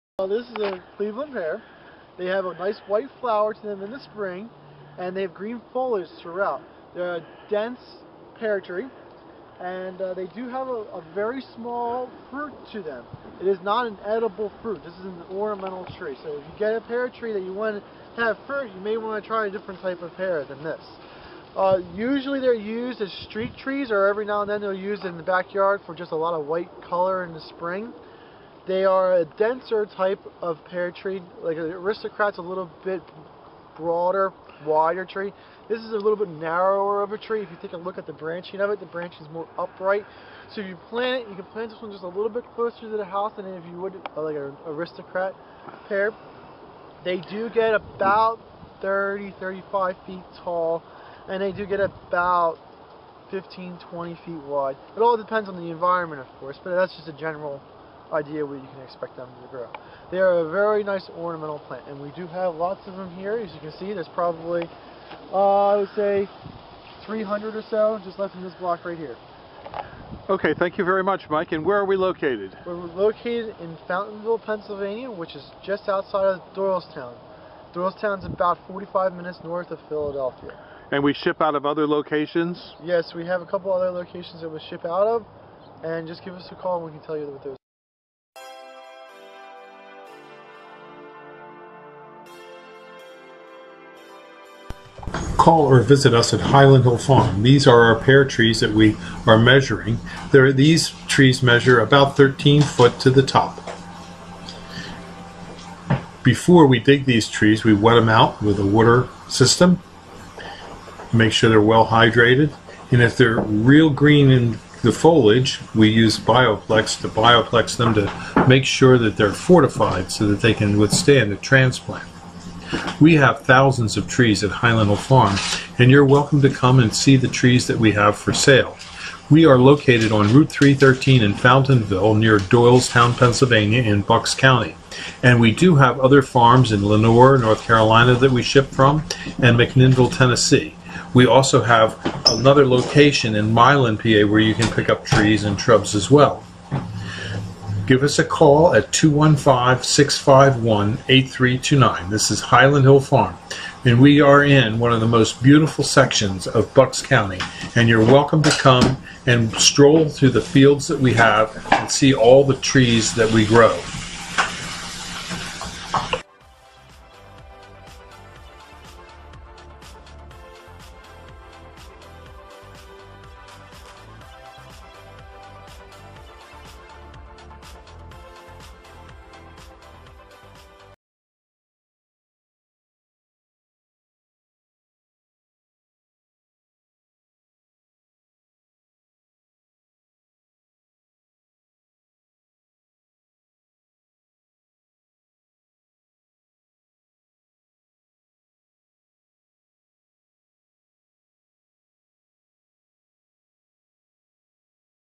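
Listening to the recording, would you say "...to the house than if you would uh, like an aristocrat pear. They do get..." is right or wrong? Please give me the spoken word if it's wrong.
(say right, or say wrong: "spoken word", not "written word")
right.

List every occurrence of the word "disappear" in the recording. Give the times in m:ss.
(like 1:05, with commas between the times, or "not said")
not said.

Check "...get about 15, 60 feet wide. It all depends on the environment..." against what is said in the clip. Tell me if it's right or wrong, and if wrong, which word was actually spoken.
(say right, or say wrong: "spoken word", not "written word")
wrong: "20", not "60".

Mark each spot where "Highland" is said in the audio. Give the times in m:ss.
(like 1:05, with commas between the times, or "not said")
1:36, 2:04, 2:32.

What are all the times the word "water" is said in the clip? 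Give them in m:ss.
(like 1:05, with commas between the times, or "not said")
1:48.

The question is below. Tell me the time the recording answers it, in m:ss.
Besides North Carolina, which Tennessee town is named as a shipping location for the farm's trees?
2:19.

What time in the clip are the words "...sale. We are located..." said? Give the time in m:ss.
2:08.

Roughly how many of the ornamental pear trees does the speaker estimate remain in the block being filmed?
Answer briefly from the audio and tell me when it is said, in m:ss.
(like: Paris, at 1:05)
300, at 1:07.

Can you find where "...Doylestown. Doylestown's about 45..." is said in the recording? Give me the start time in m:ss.
1:16.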